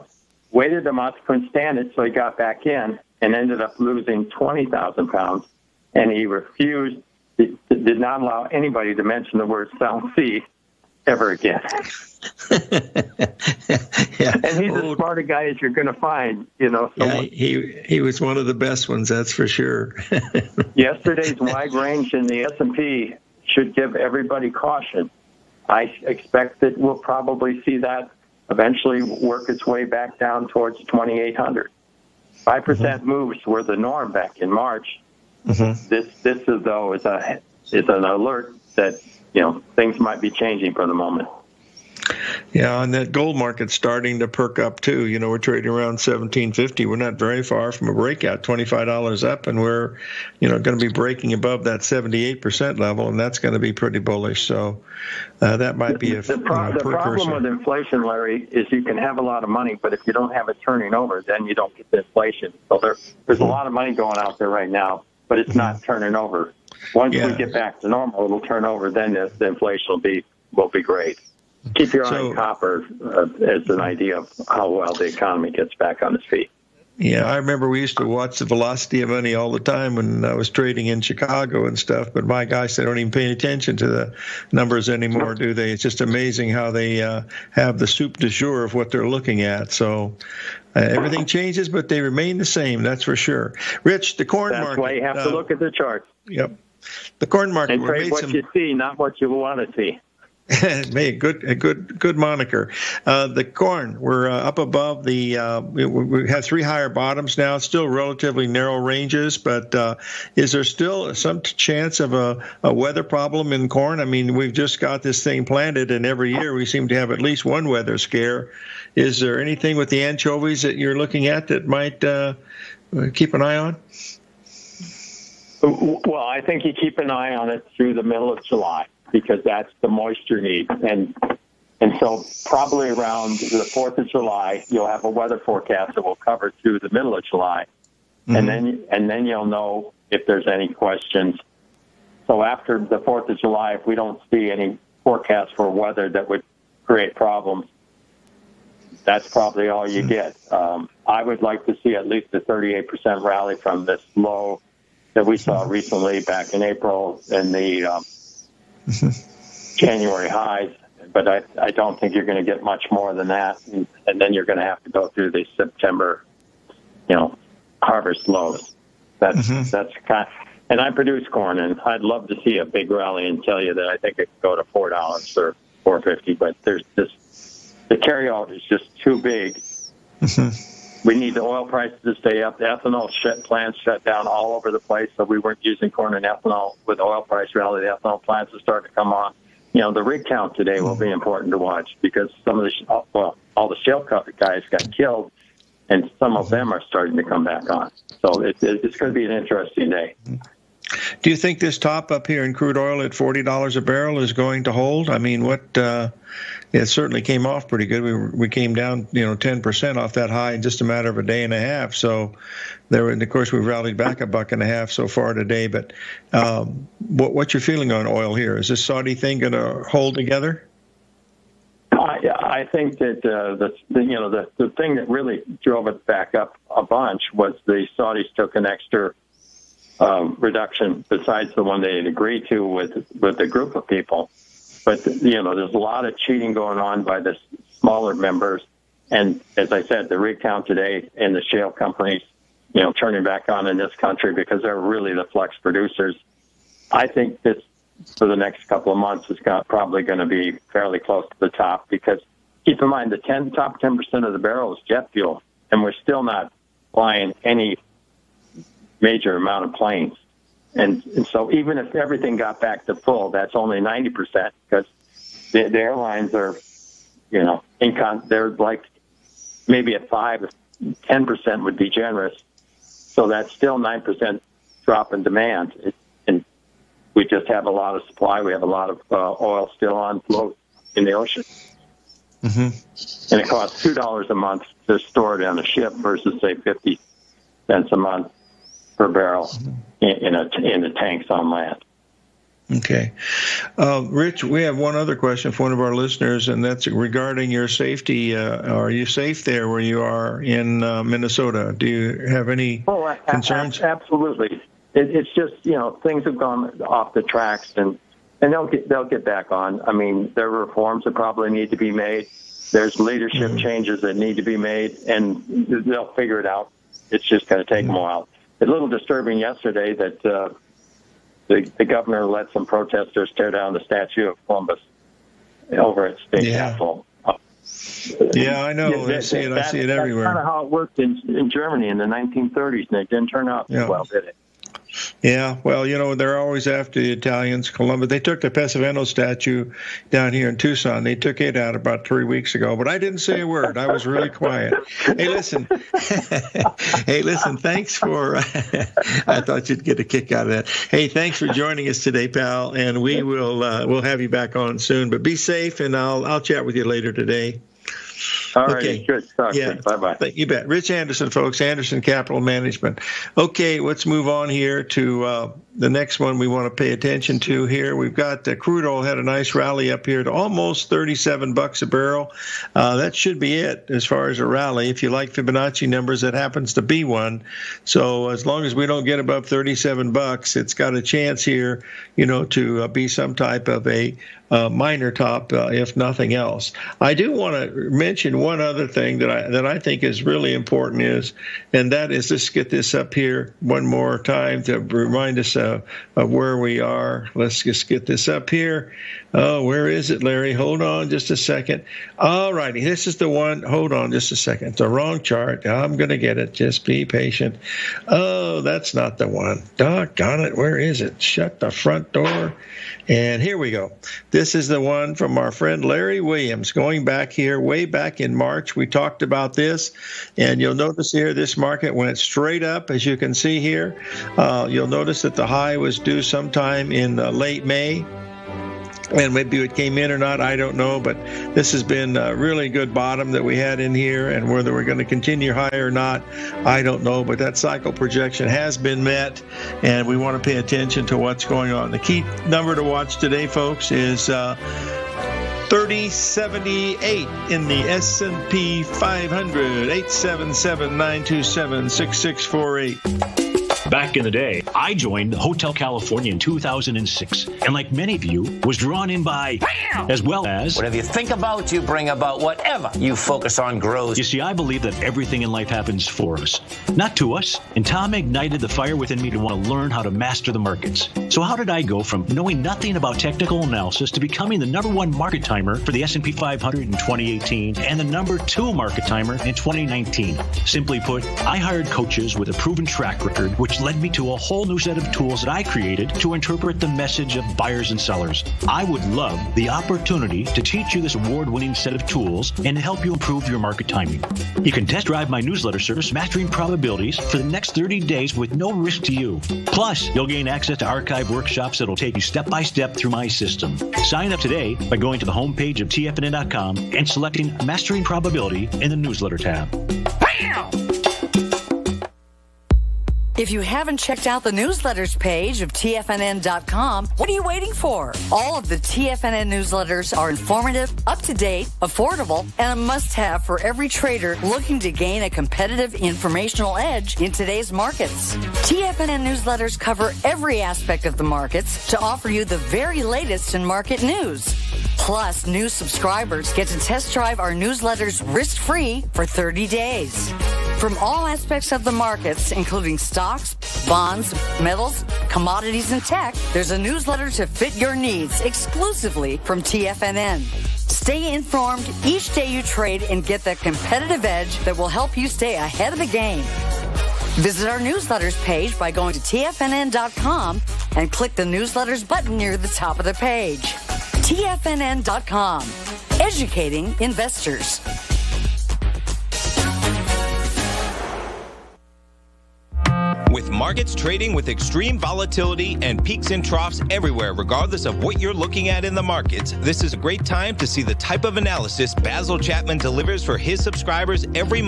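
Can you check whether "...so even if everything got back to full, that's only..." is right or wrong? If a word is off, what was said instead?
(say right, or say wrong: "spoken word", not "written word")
right.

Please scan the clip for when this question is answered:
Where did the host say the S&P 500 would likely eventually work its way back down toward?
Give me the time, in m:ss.
0:30.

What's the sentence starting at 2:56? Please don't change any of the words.
But there's just the carryout is just too big.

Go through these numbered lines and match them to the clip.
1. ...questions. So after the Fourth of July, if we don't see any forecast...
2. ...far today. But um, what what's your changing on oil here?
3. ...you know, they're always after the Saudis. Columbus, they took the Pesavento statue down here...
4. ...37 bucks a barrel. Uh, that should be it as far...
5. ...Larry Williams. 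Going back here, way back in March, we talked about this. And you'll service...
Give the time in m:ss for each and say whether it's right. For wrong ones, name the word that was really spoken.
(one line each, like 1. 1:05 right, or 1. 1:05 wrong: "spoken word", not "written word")
1. 2:20 right
2. 3:35 wrong: "feeling", not "changing"
3. 5:35 wrong: "Italians", not "Saudis"
4. 6:10 right
5. 6:55 wrong: "notice", not "service".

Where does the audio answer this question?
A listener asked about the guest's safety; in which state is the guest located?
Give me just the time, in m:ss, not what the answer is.
5:01.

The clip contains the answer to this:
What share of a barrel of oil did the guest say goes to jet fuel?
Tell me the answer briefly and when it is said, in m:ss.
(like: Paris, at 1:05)
10 percent, at 4:13.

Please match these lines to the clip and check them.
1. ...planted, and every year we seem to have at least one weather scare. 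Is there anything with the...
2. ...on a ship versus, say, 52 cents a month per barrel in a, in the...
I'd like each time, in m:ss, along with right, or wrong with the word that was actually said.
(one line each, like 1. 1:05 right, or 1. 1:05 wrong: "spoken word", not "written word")
1. 1:55 right
2. 4:45 wrong: "50", not "52".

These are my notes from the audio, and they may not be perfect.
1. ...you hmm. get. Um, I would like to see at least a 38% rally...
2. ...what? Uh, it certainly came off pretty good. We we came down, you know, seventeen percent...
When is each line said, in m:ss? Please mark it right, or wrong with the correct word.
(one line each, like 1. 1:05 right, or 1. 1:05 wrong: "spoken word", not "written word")
1. 2:29 right
2. 3:25 wrong: "ten", not "seventeen".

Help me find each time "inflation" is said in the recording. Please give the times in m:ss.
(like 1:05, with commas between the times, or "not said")
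0:57, 1:01, 1:09.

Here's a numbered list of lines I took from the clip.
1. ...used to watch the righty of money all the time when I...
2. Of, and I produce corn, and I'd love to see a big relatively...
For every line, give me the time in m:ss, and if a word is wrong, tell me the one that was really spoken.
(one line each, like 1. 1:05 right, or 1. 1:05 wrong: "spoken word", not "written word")
1. 1:17 wrong: "velocity", not "righty"
2. 2:50 wrong: "rally", not "relatively".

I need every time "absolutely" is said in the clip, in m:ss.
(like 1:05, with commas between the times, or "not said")
5:03.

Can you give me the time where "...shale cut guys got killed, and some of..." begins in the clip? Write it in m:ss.
3:13.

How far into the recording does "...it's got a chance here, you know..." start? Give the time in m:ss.
6:20.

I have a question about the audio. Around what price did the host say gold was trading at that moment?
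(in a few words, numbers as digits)
1750.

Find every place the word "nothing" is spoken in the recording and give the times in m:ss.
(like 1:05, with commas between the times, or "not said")
6:25, 7:52.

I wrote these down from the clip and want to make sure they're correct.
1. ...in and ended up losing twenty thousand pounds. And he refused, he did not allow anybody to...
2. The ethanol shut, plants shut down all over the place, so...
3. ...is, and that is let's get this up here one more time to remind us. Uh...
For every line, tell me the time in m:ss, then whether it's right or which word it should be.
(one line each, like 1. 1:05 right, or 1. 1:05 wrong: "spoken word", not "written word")
1. 0:02 right
2. 3:02 right
3. 6:31 right.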